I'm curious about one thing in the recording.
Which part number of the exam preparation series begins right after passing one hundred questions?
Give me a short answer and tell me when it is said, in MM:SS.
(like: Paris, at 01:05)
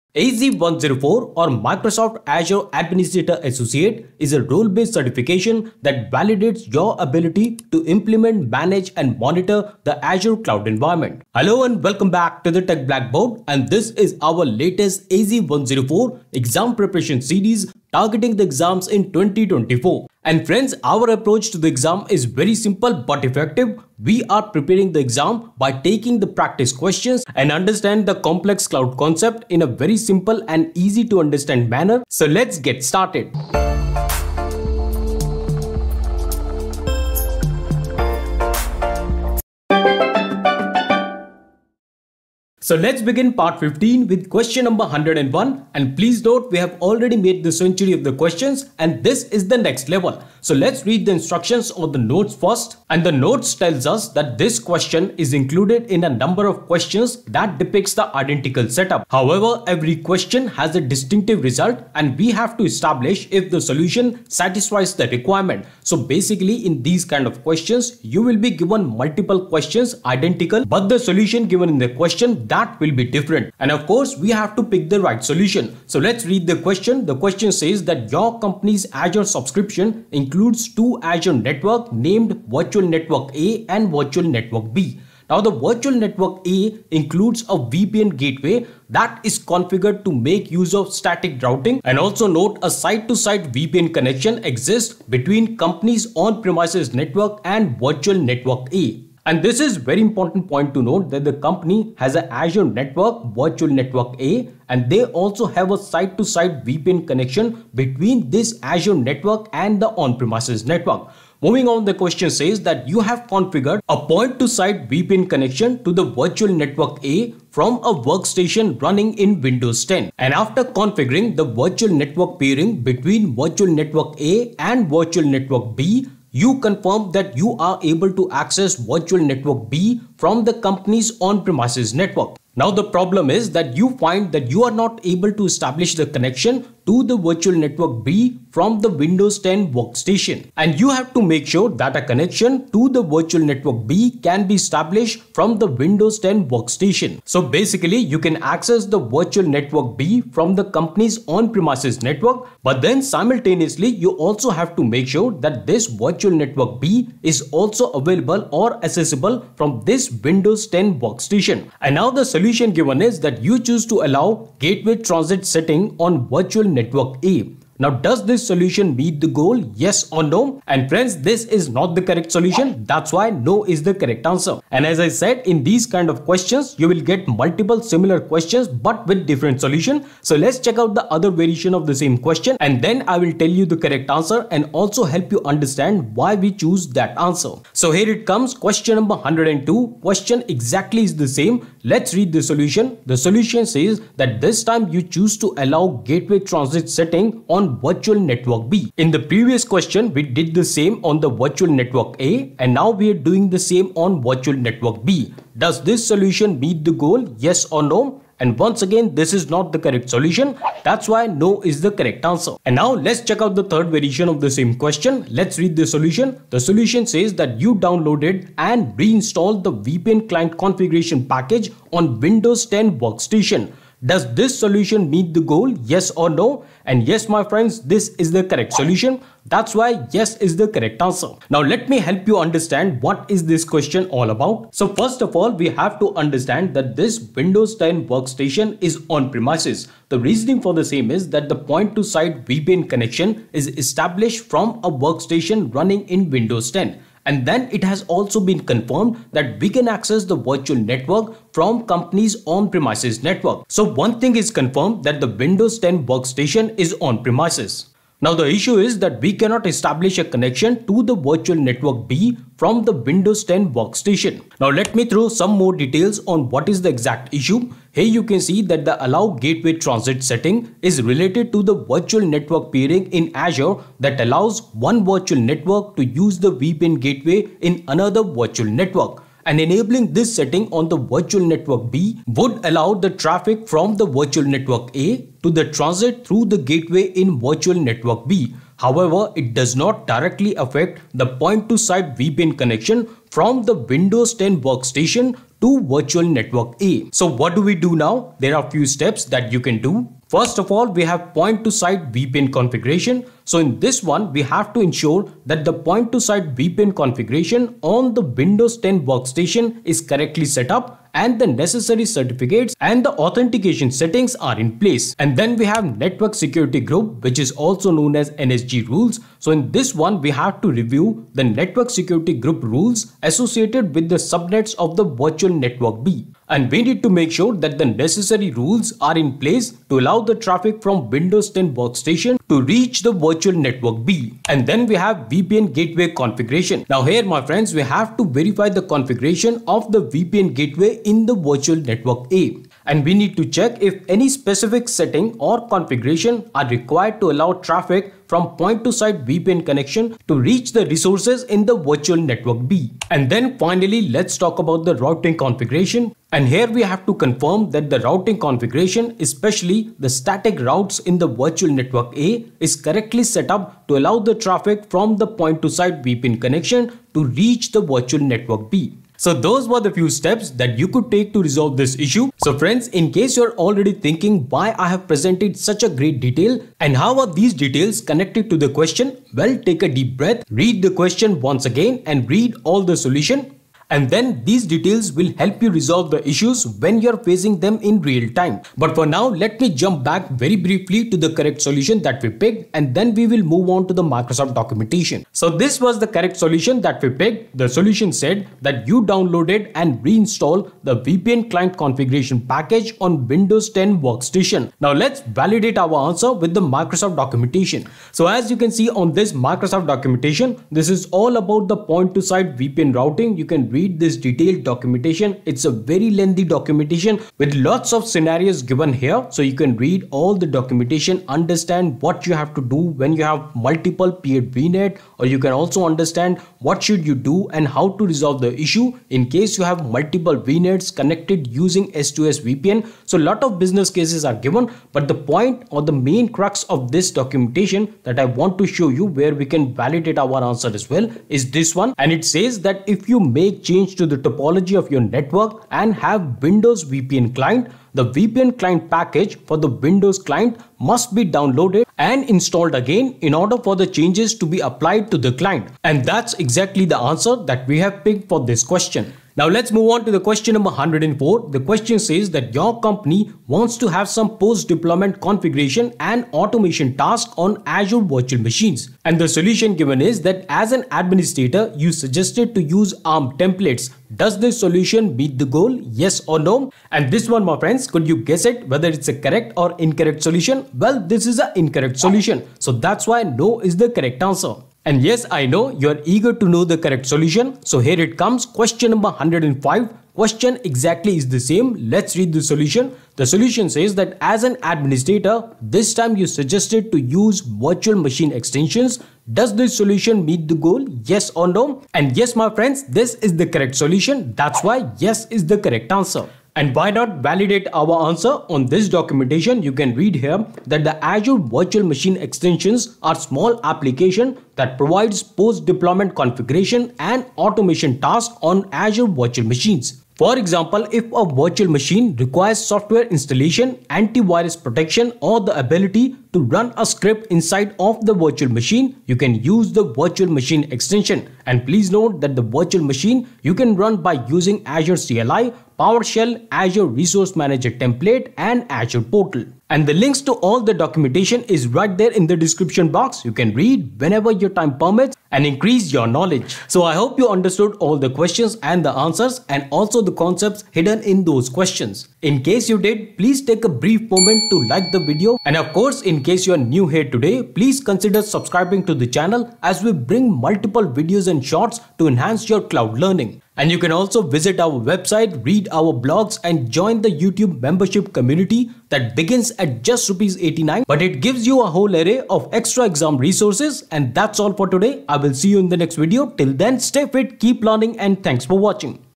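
15, at 00:43.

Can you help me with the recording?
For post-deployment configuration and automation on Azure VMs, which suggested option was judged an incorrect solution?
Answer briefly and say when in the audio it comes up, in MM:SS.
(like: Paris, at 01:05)
ARM templates, at 07:53.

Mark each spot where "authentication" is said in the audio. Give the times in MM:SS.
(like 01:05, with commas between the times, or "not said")
05:13.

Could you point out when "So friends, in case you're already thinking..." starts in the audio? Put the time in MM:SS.
06:12.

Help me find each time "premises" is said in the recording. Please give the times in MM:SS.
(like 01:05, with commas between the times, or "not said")
01:36, 01:49, 02:11, 02:31, 03:59, 04:12, 04:16.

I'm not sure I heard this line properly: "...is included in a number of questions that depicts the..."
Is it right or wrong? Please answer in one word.
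right.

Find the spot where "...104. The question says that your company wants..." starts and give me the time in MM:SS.
07:40.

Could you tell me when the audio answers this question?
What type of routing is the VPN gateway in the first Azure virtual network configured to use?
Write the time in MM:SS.
01:30.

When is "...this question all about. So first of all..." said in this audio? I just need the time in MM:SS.
03:53.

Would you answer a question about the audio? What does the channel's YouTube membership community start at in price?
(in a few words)
89 rupees.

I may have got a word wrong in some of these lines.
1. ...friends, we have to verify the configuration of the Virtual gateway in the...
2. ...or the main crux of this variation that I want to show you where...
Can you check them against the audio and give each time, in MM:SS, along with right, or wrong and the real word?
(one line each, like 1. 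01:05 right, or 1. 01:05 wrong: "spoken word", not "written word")
1. 05:37 wrong: "VPN", not "Virtual"
2. 07:15 wrong: "documentation", not "variation".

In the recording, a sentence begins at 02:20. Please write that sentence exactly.
And you have to make sure that a connection to the virtual network B can be established from the Windows 10 workstation.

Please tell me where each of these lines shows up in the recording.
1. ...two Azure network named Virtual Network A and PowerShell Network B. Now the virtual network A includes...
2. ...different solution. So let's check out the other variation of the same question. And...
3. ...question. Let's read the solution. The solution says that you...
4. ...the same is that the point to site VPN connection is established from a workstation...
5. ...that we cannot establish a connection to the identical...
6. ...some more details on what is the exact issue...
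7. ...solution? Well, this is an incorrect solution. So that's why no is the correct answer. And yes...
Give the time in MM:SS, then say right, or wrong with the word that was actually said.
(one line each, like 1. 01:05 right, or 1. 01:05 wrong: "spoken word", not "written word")
1. 01:20 wrong: "Virtual", not "PowerShell"
2. 02:59 right
3. 03:34 right
4. 04:00 right
5. 04:18 wrong: "virtual", not "identical"
6. 04:25 right
7. 08:00 right.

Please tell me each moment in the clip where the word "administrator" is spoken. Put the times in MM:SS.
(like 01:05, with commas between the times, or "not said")
00:02, 07:50, 08:14.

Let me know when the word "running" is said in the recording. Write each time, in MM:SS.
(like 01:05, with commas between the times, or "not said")
01:58, 04:05.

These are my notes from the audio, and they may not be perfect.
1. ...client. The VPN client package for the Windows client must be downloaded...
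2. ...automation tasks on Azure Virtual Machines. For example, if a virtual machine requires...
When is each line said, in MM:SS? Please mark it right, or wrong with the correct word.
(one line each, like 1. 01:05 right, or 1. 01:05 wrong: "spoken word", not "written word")
1. 07:27 right
2. 08:37 right.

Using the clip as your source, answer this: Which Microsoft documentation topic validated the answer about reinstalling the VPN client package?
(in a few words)
point to site VPN routing.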